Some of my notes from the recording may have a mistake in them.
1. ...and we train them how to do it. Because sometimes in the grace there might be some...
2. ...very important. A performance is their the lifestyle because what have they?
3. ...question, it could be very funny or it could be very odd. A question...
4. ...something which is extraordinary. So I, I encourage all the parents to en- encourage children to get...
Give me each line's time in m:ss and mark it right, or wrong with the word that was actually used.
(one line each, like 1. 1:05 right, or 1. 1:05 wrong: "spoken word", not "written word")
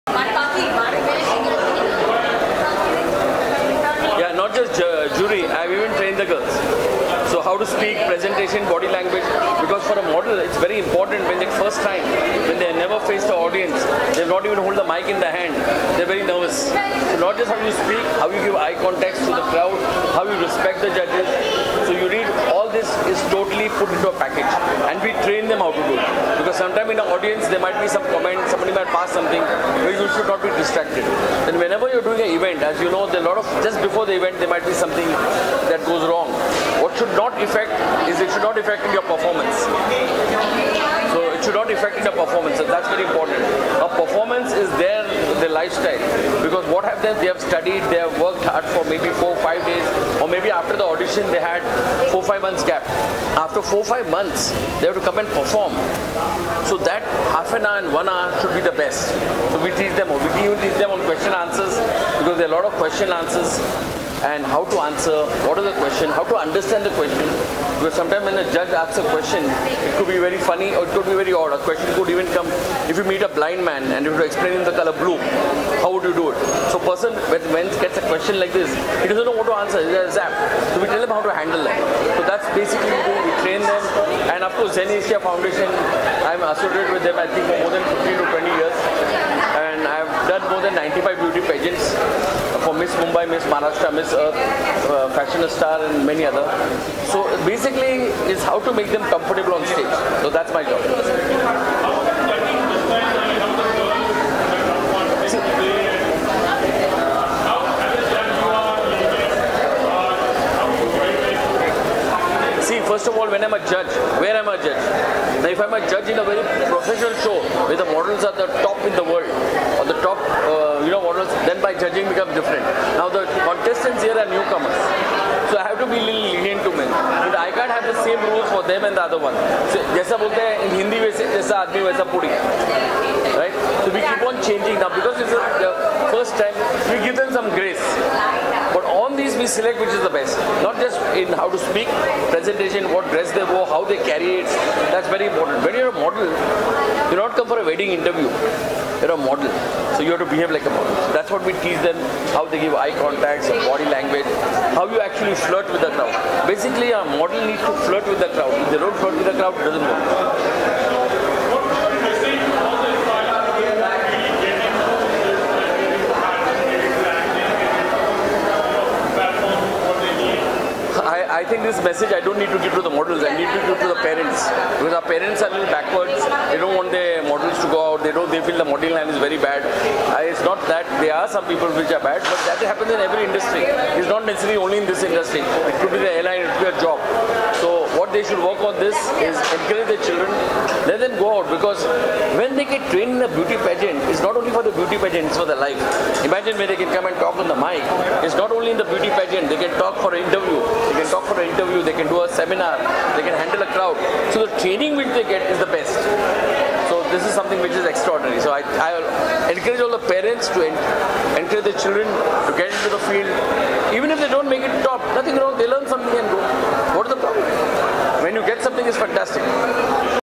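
1. 0:24 wrong: "audience", not "grace"
2. 0:42 right
3. 1:09 right
4. 3:27 right.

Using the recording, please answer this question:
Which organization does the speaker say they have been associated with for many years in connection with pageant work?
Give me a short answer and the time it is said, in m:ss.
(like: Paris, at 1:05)
Zen Asia Foundation, at 1:24.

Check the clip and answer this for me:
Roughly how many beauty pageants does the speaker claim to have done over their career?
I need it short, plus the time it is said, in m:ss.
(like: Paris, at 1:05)
95, at 1:30.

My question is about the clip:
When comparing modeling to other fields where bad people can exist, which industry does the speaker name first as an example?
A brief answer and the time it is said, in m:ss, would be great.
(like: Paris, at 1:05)
airline, at 3:06.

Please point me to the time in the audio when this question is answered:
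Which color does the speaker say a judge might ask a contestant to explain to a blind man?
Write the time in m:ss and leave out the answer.
1:14.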